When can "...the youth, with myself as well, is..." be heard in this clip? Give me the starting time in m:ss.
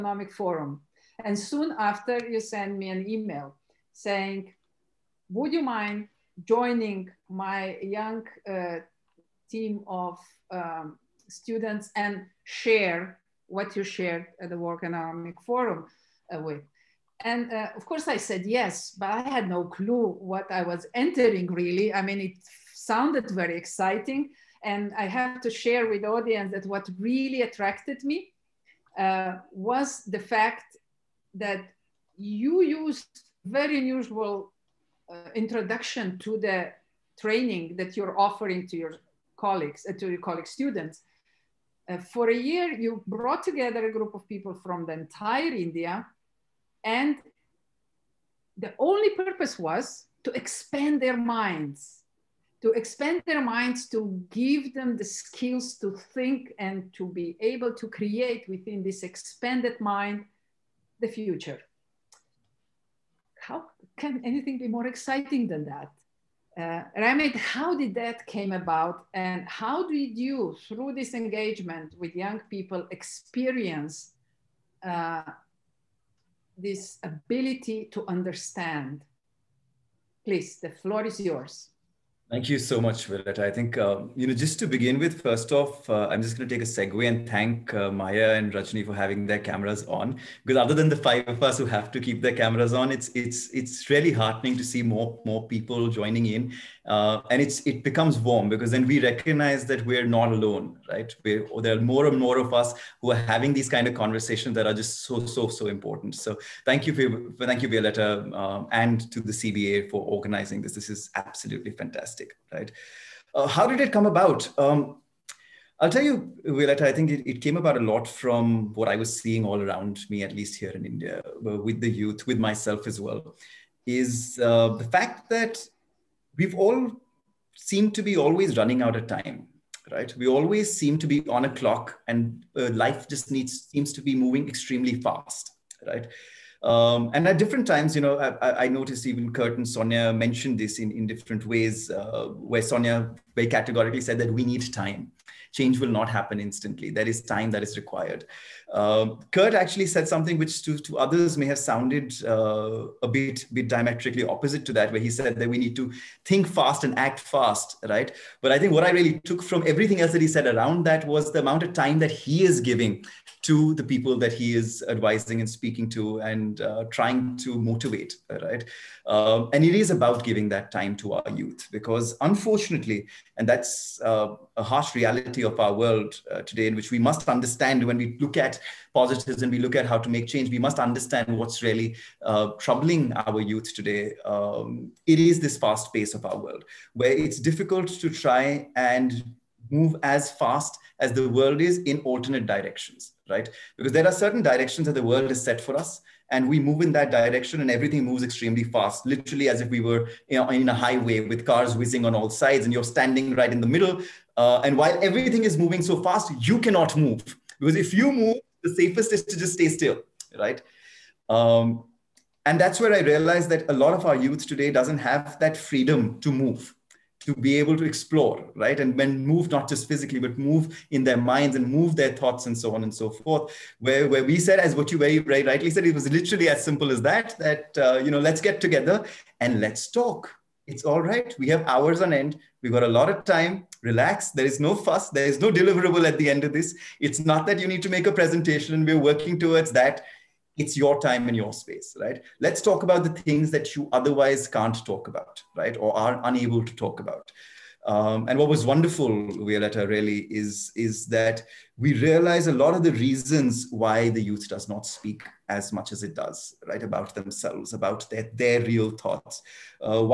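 2:01.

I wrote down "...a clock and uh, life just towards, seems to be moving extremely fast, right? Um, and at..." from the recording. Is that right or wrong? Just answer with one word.
wrong.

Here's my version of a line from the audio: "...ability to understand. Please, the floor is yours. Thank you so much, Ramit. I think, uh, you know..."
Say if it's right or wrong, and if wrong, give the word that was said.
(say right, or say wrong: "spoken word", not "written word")
wrong: "Willett", not "Ramit".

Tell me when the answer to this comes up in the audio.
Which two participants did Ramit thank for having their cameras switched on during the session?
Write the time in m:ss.
1:27.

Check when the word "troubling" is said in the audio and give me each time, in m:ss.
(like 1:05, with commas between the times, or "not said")
3:02.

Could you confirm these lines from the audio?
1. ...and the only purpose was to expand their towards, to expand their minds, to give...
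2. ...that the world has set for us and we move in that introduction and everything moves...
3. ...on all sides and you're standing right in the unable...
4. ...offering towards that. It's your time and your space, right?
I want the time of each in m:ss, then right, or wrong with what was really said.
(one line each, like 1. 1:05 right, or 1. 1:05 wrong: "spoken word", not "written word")
1. 0:46 wrong: "minds", not "towards"
2. 3:14 wrong: "direction", not "introduction"
3. 3:22 wrong: "middle", not "unable"
4. 3:58 wrong: "working", not "offering".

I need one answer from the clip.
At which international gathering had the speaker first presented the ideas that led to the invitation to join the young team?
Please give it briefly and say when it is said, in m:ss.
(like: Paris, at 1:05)
World Economic Forum, at 0:14.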